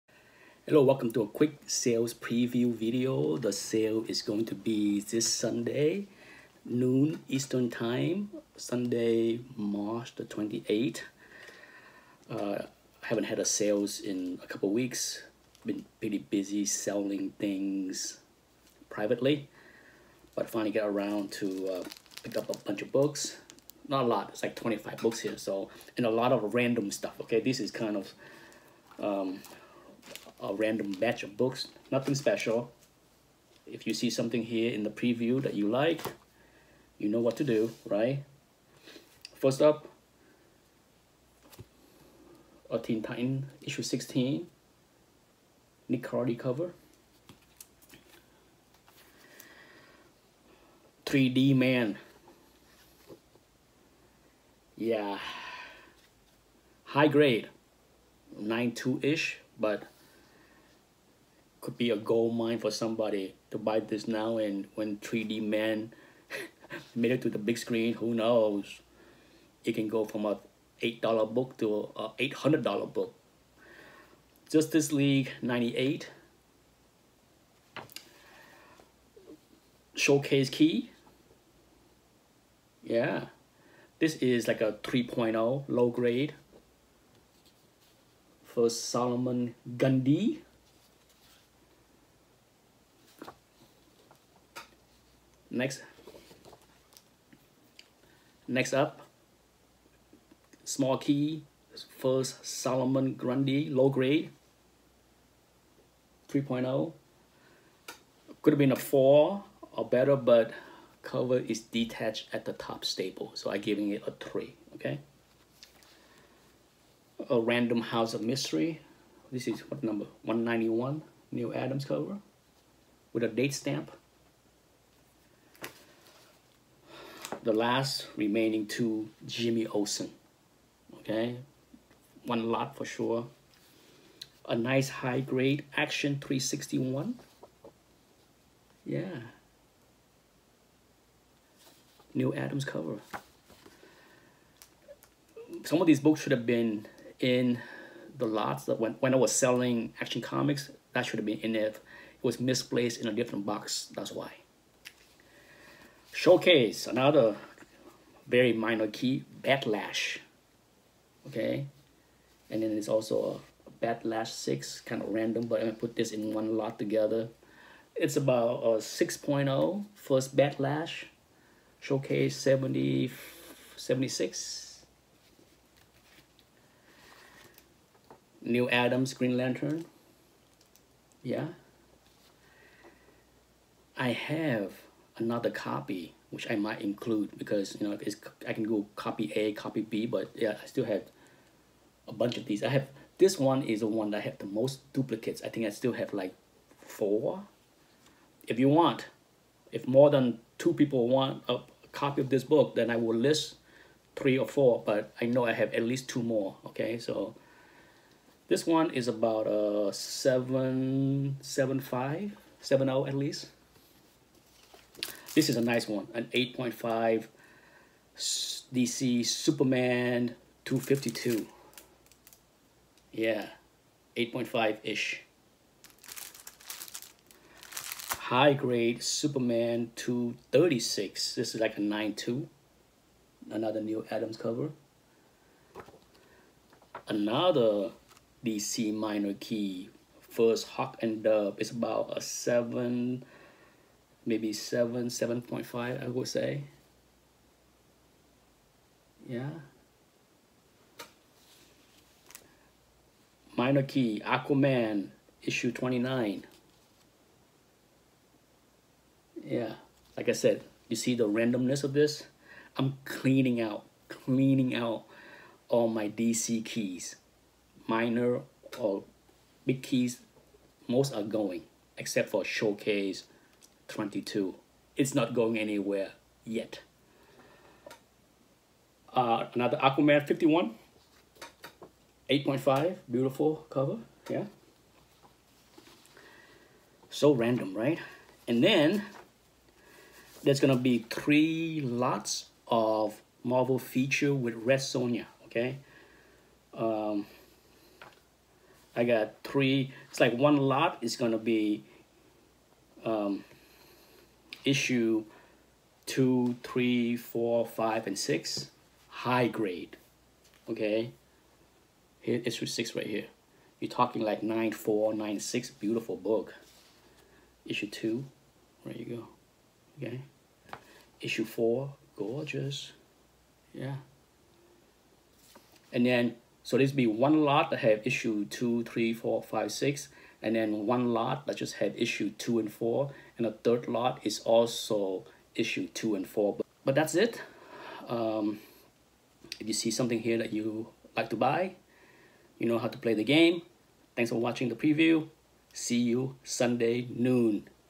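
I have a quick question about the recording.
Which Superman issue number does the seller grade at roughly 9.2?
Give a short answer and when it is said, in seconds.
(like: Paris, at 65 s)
236, at 229 s.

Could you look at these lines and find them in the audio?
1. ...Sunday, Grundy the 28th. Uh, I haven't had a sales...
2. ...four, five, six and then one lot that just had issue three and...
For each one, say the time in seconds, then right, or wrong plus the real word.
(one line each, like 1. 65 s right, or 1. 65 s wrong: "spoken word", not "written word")
1. 8 s wrong: "March", not "Grundy"
2. 329 s wrong: "two", not "three".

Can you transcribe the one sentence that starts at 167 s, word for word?
It's about a 6.0 first Bat Lash, showcase 70, 76.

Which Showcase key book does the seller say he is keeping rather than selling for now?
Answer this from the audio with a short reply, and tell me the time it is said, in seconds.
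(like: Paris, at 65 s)
Showcase 22, at 272 s.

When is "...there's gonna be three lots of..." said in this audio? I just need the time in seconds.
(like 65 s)
290 s.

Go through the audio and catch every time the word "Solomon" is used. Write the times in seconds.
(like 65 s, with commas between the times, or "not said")
88 s, 102 s.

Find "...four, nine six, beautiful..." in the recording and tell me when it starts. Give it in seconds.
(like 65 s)
314 s.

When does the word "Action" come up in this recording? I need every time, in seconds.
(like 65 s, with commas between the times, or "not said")
135 s, 150 s.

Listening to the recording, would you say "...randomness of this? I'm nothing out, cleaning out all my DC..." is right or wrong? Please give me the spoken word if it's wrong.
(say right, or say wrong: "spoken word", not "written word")
wrong: "cleaning", not "nothing".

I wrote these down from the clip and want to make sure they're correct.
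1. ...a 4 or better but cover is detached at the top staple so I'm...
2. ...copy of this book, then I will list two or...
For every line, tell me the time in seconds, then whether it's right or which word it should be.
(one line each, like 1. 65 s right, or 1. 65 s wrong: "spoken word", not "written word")
1. 108 s right
2. 201 s wrong: "three", not "two".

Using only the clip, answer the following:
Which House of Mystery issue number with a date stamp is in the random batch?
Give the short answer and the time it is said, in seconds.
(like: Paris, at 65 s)
191, at 120 s.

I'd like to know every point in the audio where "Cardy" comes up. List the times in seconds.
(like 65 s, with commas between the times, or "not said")
46 s.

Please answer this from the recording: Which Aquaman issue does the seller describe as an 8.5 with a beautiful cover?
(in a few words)
51.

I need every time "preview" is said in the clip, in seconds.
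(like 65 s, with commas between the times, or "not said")
2 s, 34 s, 344 s.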